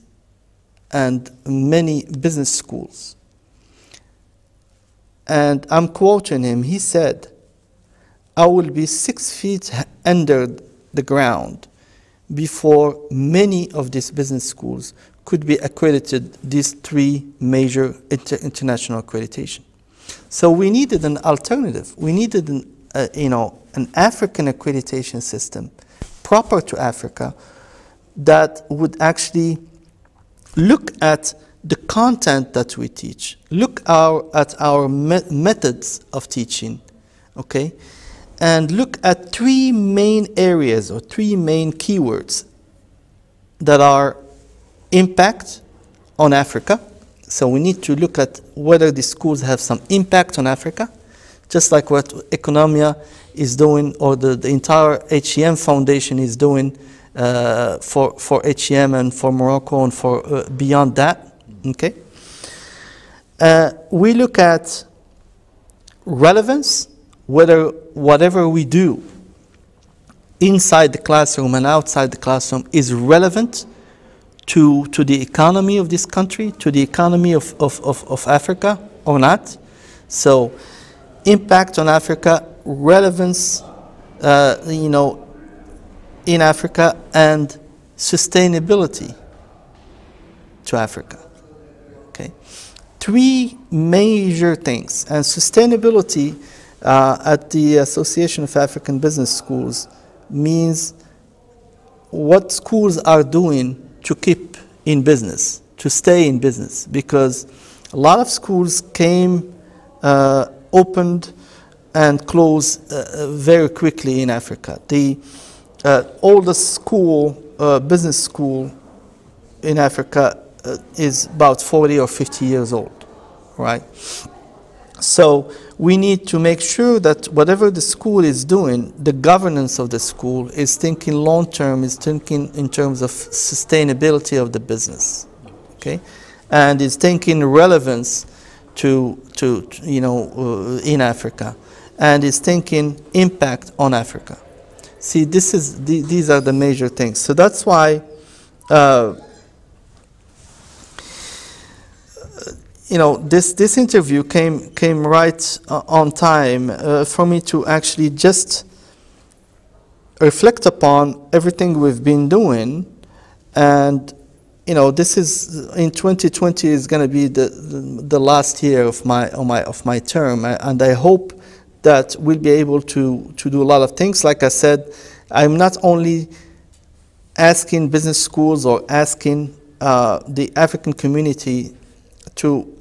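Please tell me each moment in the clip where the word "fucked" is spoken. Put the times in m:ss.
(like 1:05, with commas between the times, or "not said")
not said.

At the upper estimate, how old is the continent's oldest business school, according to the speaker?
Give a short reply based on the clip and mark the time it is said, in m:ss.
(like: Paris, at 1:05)
50, at 2:02.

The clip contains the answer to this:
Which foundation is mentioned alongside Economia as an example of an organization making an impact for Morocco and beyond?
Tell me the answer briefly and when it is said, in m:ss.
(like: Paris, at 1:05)
HEM Foundation, at 0:55.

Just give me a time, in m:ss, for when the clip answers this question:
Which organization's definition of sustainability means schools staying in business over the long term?
1:37.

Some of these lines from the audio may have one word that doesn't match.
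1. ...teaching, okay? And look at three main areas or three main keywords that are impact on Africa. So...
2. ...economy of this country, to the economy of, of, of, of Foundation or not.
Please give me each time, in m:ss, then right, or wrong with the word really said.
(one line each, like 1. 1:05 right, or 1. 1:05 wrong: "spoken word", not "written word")
1. 0:36 right
2. 1:15 wrong: "Africa", not "Foundation".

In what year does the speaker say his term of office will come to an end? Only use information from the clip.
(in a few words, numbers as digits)
2020.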